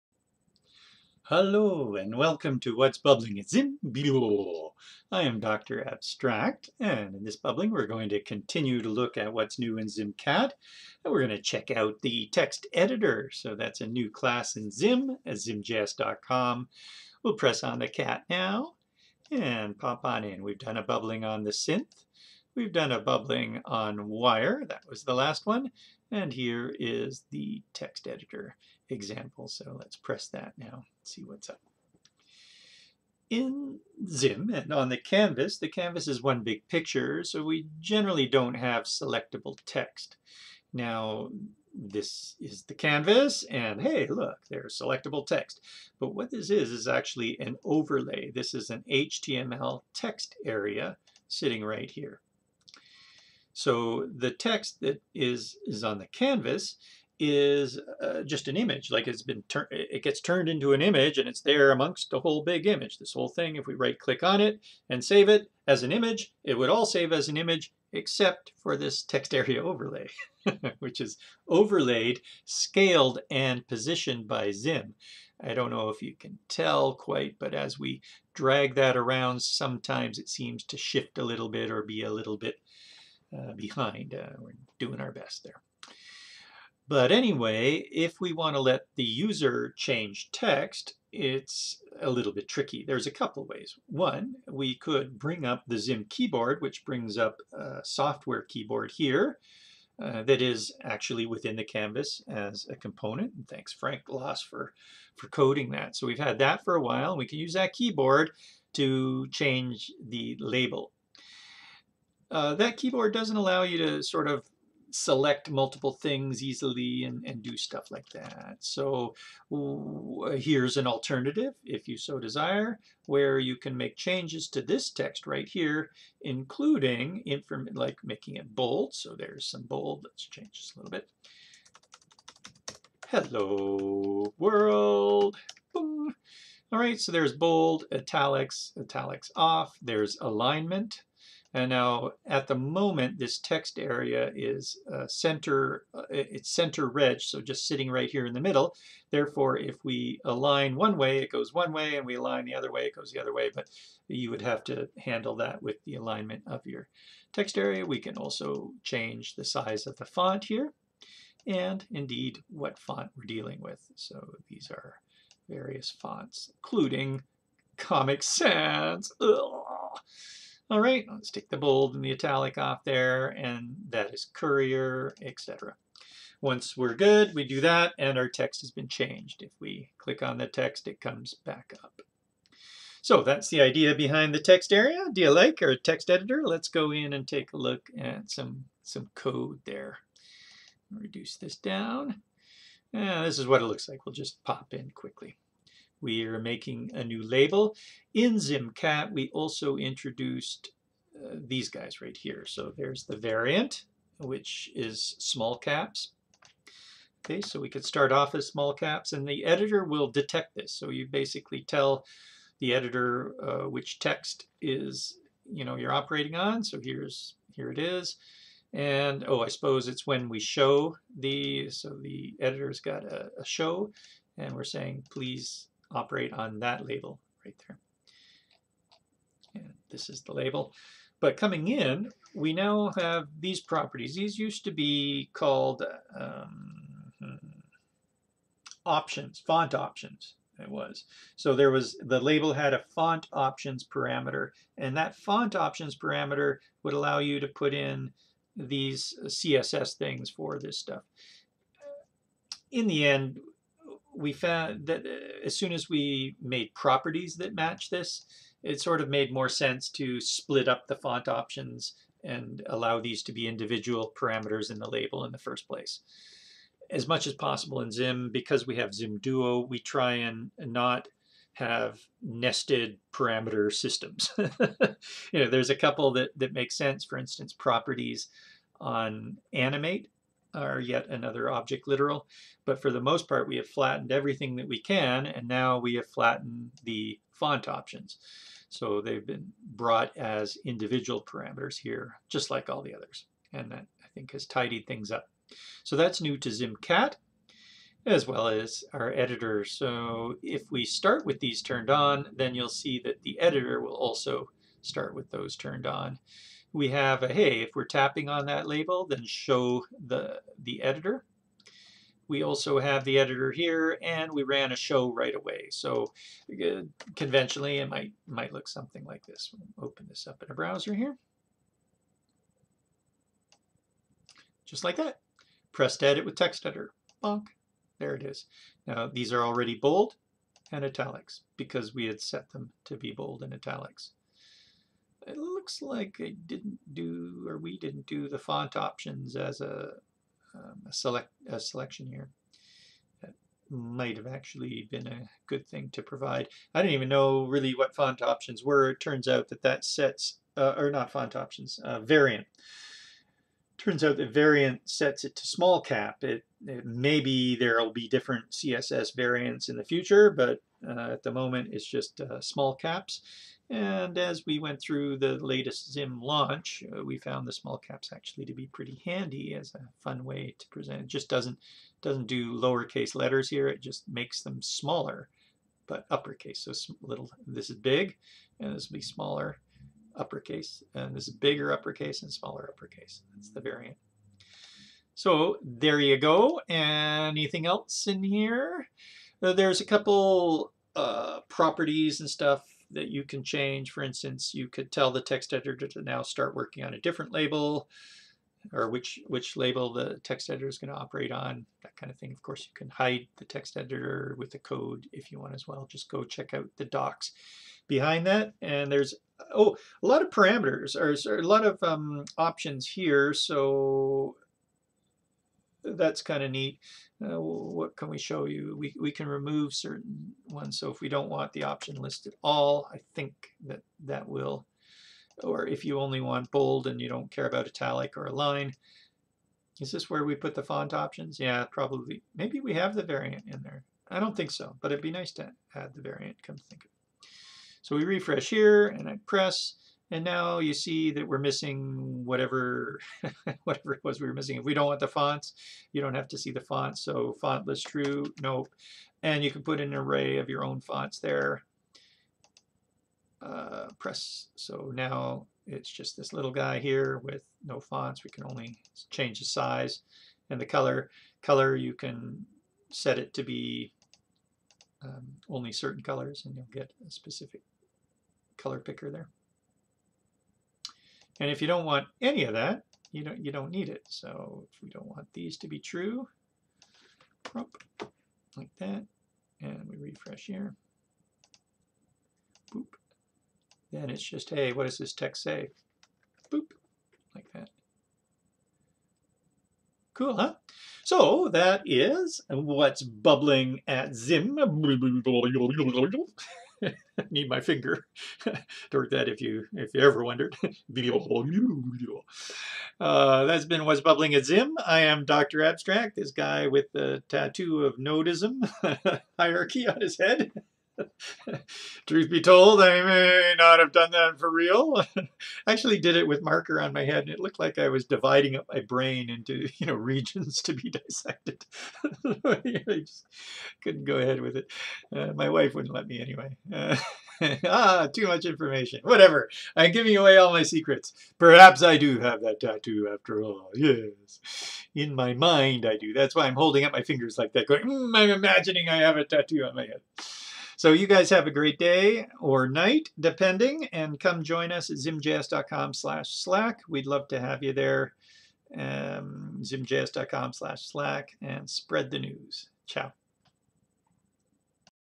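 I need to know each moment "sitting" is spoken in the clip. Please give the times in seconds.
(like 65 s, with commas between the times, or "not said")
51 s, 147 s.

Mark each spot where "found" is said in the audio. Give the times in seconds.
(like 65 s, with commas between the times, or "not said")
254 s, 367 s.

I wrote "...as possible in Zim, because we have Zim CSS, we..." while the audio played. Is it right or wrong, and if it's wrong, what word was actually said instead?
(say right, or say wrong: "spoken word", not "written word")
wrong: "Duo", not "CSS".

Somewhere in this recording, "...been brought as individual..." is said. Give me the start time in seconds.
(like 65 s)
289 s.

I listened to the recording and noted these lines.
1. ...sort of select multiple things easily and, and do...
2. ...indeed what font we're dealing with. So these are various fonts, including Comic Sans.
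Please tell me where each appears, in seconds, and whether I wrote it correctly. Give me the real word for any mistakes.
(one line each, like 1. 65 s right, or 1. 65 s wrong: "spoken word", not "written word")
1. 114 s right
2. 161 s right.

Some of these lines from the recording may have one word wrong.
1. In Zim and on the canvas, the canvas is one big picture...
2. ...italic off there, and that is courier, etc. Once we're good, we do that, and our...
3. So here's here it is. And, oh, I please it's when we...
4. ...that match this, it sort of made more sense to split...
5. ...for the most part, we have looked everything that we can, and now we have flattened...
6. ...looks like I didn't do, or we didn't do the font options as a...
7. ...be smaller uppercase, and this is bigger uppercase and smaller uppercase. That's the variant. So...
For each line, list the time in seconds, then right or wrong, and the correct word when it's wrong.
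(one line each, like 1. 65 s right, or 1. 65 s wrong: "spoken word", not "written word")
1. 33 s right
2. 172 s right
3. 216 s wrong: "suppose", not "please"
4. 257 s right
5. 282 s wrong: "flattened", not "looked"
6. 335 s right
7. 378 s right.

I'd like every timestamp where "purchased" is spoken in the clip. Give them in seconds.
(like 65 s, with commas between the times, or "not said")
not said.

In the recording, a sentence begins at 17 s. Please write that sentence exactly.
We'll press on the cat now and pop on in.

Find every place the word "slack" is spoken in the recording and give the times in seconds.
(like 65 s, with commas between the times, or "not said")
546 s, 550 s.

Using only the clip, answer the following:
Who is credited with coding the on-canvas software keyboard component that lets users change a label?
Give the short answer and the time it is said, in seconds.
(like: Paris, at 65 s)
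Frank Los, at 103 s.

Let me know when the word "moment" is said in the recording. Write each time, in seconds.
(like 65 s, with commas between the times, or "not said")
142 s, 361 s.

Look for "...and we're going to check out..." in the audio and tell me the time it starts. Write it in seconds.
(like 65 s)
11 s.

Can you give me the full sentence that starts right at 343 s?
That might have actually been a good thing to provide.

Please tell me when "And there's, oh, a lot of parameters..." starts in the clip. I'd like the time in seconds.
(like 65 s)
408 s.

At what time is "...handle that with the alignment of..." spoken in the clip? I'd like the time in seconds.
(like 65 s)
154 s.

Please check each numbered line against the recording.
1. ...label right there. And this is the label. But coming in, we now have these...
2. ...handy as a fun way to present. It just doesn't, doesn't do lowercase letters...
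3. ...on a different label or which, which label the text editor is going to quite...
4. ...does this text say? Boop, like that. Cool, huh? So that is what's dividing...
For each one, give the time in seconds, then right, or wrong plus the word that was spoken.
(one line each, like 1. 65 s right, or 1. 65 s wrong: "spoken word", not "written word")
1. 226 s right
2. 369 s right
3. 396 s wrong: "operate", not "quite"
4. 484 s wrong: "bubbling", not "dividing".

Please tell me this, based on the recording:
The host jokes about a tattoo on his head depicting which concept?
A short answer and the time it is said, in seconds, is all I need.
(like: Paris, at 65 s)
nodism hierarchy, at 507 s.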